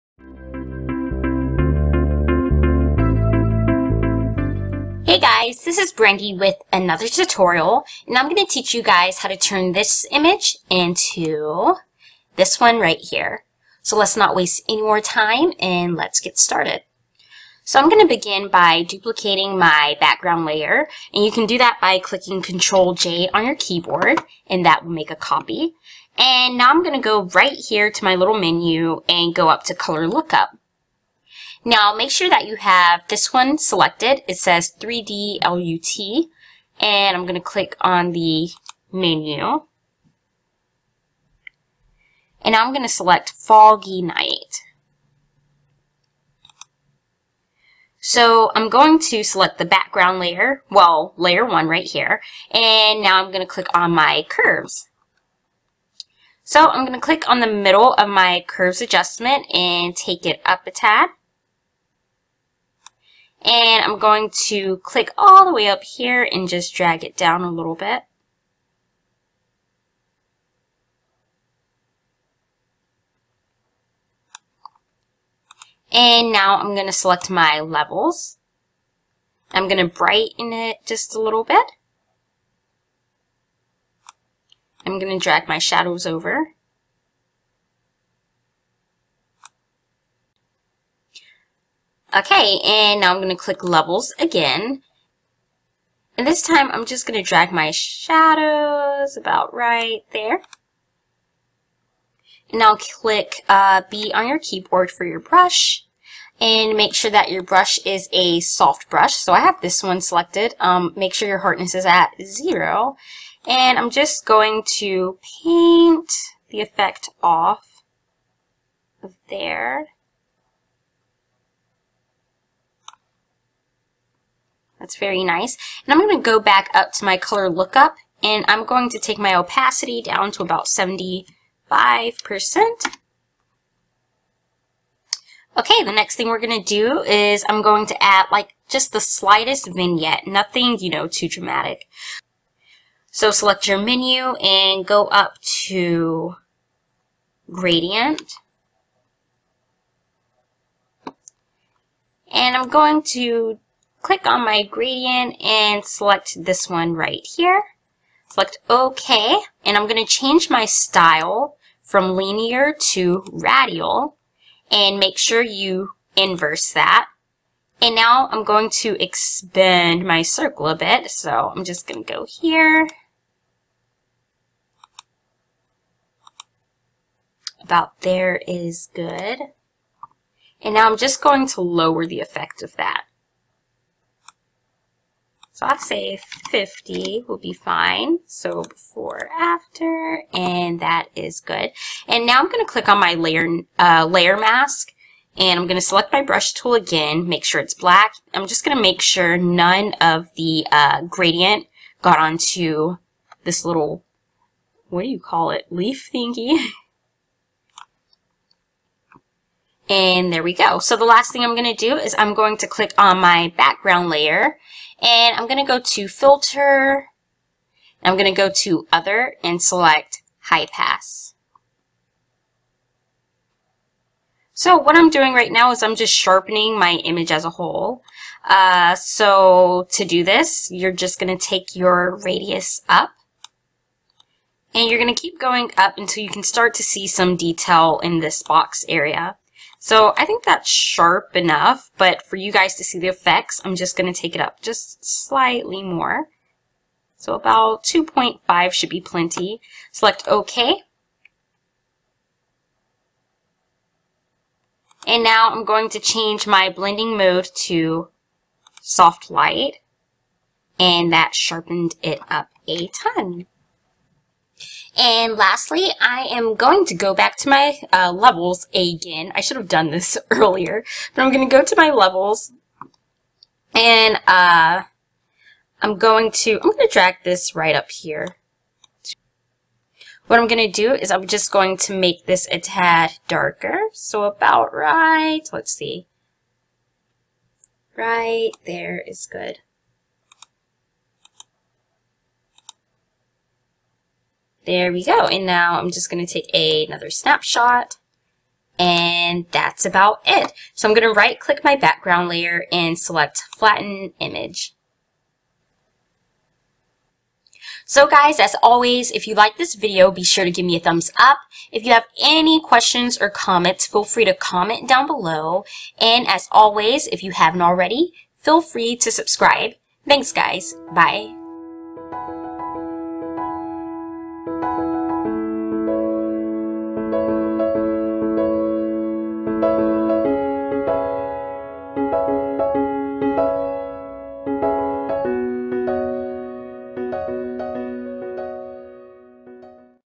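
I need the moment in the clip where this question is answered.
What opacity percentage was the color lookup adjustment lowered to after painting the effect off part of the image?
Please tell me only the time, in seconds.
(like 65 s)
130 s.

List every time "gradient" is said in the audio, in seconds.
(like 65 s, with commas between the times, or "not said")
147 s, 154 s, 201 s.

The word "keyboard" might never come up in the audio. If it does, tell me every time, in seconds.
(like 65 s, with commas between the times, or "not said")
23 s, 104 s.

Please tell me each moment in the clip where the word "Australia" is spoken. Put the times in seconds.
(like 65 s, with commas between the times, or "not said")
not said.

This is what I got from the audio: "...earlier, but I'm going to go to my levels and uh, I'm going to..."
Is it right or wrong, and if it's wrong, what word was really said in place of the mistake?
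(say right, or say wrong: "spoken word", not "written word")
right.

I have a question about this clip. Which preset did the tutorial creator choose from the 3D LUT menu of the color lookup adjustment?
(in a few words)
Foggy Night.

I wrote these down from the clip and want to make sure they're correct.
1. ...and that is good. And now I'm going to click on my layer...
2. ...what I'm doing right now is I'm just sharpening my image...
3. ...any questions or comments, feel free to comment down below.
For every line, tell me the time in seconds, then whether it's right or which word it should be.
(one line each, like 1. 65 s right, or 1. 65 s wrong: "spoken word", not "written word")
1. 190 s right
2. 224 s right
3. 312 s right.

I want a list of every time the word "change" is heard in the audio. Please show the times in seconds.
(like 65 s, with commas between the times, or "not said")
160 s, 255 s.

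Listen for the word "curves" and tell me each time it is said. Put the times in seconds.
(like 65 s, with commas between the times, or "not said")
54 s, 58 s.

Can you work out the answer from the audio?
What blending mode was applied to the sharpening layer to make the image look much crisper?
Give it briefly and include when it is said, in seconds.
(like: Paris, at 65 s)
soft light, at 258 s.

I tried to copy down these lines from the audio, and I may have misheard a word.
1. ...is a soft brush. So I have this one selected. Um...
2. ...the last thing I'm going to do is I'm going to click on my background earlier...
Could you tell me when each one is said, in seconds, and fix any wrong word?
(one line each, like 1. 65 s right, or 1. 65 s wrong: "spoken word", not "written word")
1. 107 s right
2. 210 s wrong: "layer", not "earlier".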